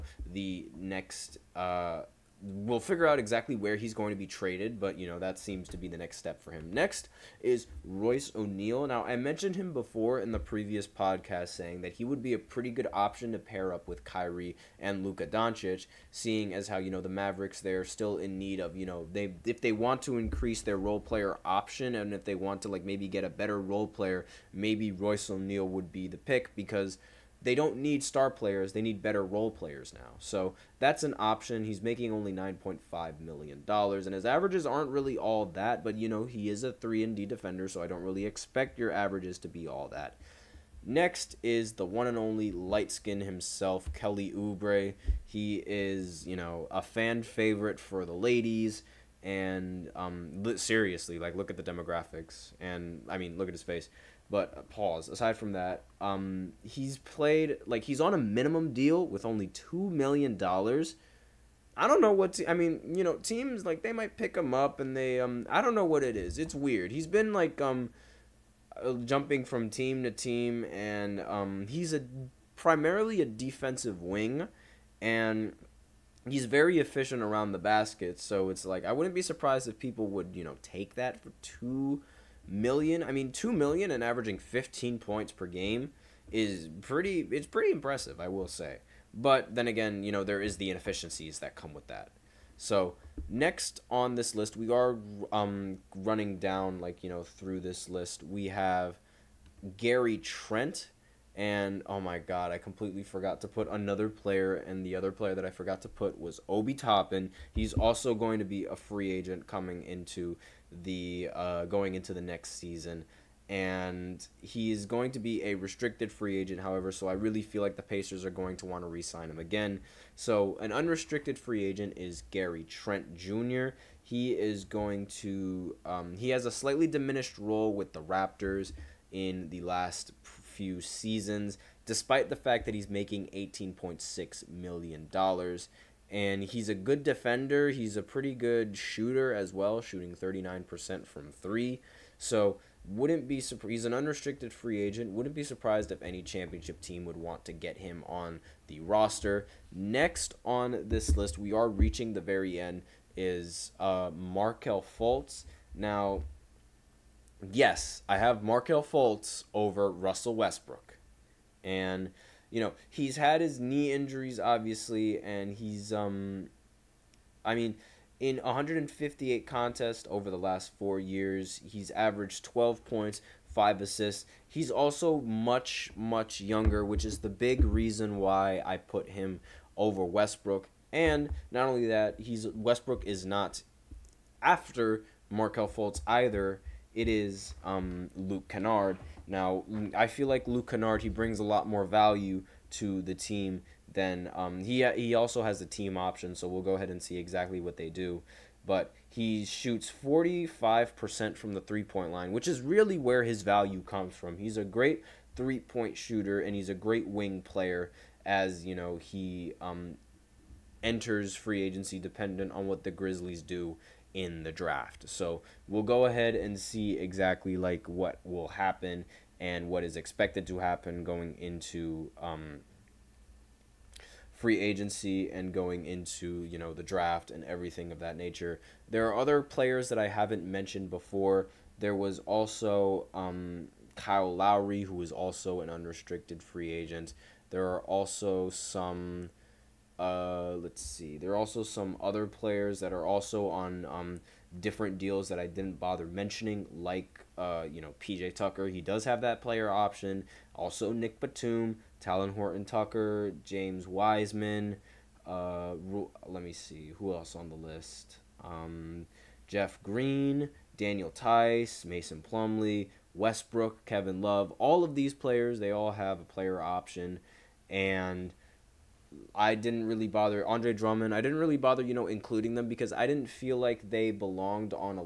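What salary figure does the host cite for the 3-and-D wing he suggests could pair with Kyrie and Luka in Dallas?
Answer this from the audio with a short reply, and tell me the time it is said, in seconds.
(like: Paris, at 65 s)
$9.5 million, at 32 s.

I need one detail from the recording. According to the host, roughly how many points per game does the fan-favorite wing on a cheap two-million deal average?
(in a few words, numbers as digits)
15.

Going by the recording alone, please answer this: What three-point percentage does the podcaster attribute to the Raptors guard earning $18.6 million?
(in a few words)
39%.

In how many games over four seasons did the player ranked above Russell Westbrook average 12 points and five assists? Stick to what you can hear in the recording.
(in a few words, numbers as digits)
158.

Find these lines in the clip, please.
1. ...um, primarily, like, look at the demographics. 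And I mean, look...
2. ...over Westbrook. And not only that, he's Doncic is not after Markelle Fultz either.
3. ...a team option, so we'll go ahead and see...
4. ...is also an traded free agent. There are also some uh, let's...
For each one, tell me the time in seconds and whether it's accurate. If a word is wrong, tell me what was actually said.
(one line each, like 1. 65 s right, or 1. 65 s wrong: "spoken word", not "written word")
1. 49 s wrong: "seriously", not "primarily"
2. 179 s wrong: "Westbrook", not "Doncic"
3. 195 s right
4. 235 s wrong: "unrestricted", not "traded".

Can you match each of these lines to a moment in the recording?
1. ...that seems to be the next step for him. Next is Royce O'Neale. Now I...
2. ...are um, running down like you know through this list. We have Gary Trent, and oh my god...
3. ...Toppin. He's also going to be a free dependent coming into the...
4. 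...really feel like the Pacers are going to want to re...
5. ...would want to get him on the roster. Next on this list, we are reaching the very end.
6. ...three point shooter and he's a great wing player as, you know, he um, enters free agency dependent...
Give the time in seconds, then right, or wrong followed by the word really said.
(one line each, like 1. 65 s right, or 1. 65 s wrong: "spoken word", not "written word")
1. 5 s right
2. 94 s right
3. 106 s wrong: "agent", not "dependent"
4. 117 s right
5. 147 s right
6. 205 s right.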